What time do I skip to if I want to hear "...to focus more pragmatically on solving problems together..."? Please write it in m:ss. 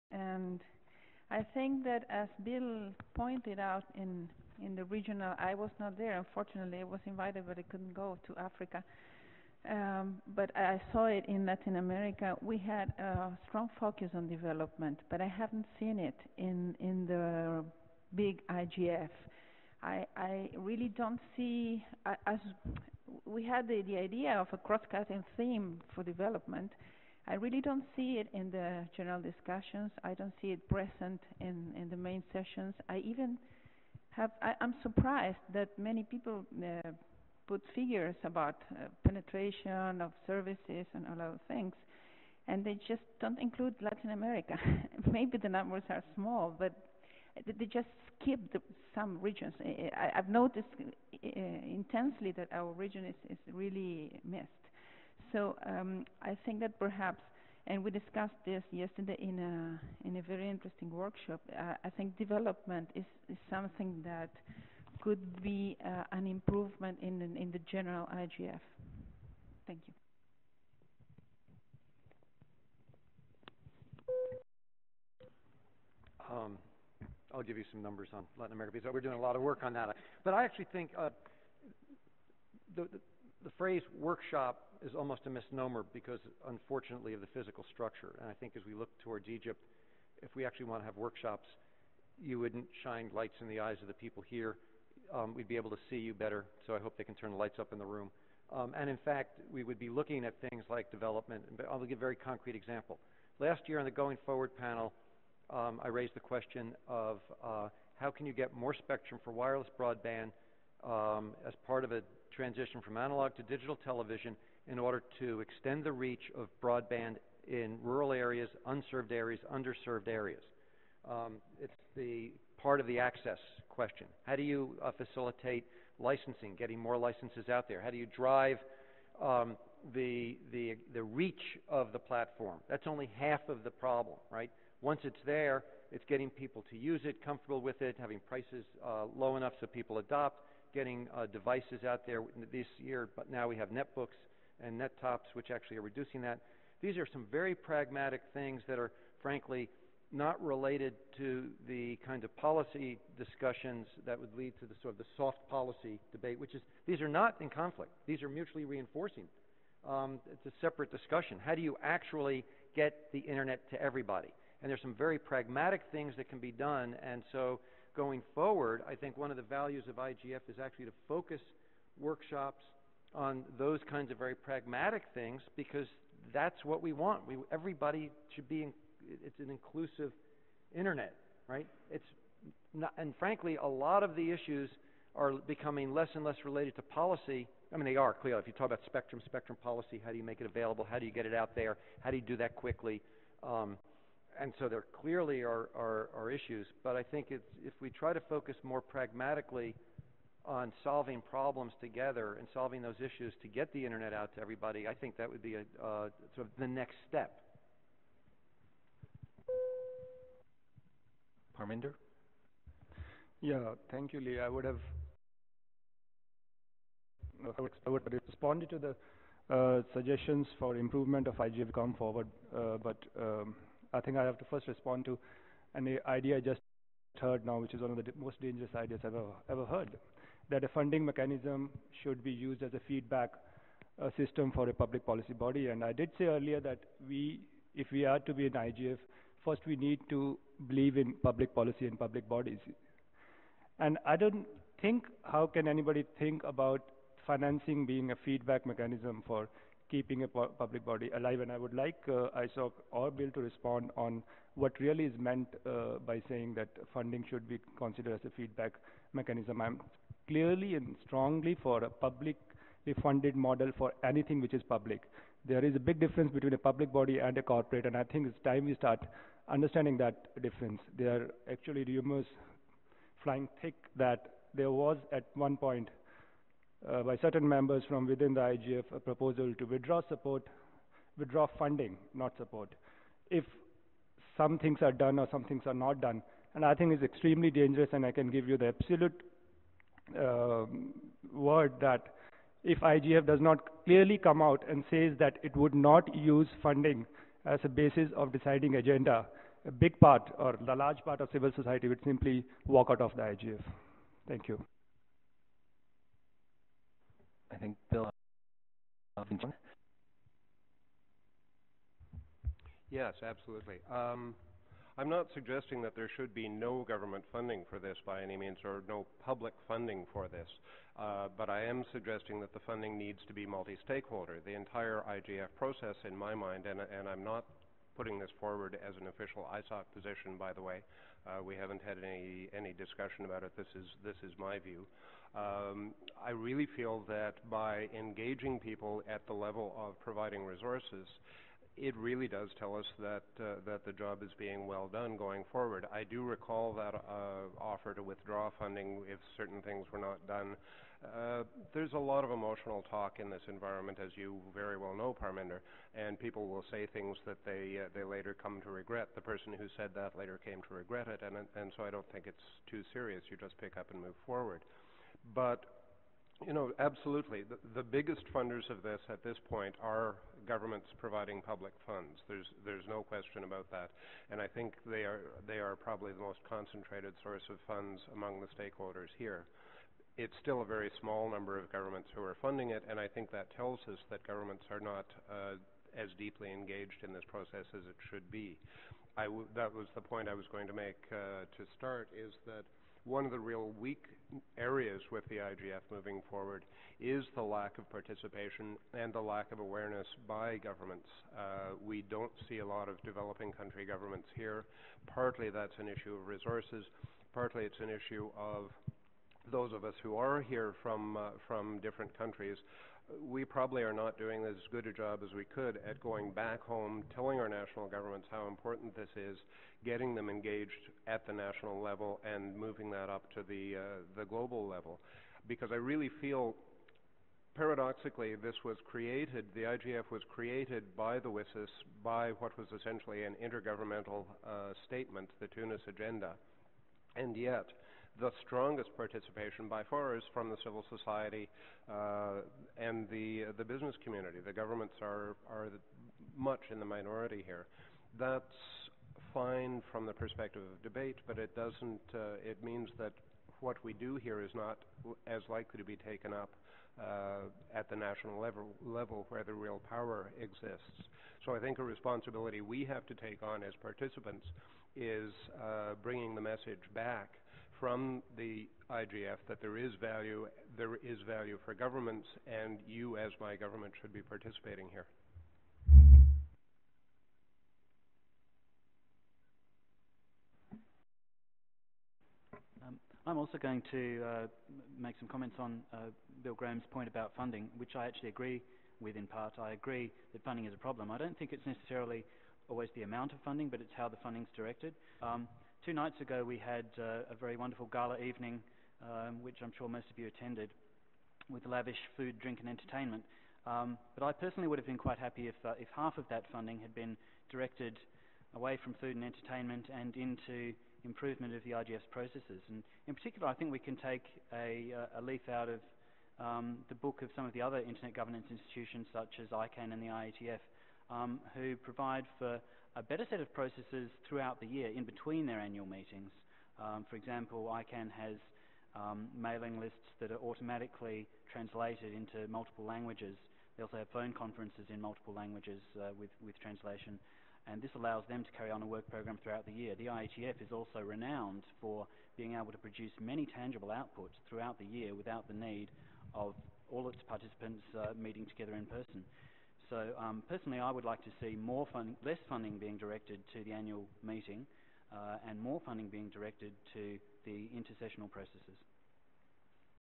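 3:18.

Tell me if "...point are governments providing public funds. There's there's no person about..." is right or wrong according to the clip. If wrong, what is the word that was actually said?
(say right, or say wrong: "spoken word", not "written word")
wrong: "question", not "person".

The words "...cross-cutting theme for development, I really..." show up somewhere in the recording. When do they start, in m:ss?
0:24.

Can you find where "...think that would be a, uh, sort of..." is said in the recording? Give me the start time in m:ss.
3:24.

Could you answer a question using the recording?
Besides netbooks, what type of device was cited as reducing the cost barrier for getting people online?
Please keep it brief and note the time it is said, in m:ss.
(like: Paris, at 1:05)
nettops, at 2:24.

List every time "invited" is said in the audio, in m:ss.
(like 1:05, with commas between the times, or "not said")
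0:07.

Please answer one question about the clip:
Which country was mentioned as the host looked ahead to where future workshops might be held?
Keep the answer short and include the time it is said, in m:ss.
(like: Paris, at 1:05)
Egypt, at 1:29.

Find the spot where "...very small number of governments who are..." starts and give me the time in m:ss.
6:20.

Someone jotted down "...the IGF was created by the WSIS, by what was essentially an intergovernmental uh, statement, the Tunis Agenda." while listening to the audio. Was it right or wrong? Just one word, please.
right.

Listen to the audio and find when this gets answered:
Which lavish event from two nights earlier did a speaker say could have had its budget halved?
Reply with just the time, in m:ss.
8:17.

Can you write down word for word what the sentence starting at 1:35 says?
Um, we'd be able to see you better, so I hope they can turn the lights up in the room.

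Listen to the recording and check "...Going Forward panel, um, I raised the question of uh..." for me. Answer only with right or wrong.
right.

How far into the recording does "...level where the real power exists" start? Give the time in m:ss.
7:38.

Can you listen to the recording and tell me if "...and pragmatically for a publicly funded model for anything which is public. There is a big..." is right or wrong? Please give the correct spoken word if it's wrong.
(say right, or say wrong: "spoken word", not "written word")
wrong: "strongly", not "pragmatically".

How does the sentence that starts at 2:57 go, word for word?
We, everybody should be, in, it's an inclusive internet, right?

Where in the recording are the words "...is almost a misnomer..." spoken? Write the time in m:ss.
1:24.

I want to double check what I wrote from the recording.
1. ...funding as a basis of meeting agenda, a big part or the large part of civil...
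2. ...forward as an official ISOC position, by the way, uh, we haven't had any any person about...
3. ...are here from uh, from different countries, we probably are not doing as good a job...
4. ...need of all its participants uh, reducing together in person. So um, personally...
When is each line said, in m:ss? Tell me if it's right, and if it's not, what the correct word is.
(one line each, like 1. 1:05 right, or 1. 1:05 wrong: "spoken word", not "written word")
1. 4:56 wrong: "deciding", not "meeting"
2. 5:28 wrong: "discussion", not "person"
3. 6:50 right
4. 9:05 wrong: "meeting", not "reducing".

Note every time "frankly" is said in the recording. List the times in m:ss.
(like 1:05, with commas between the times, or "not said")
2:29, 3:03.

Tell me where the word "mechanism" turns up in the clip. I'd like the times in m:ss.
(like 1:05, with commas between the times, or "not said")
3:51, 4:08, 4:19.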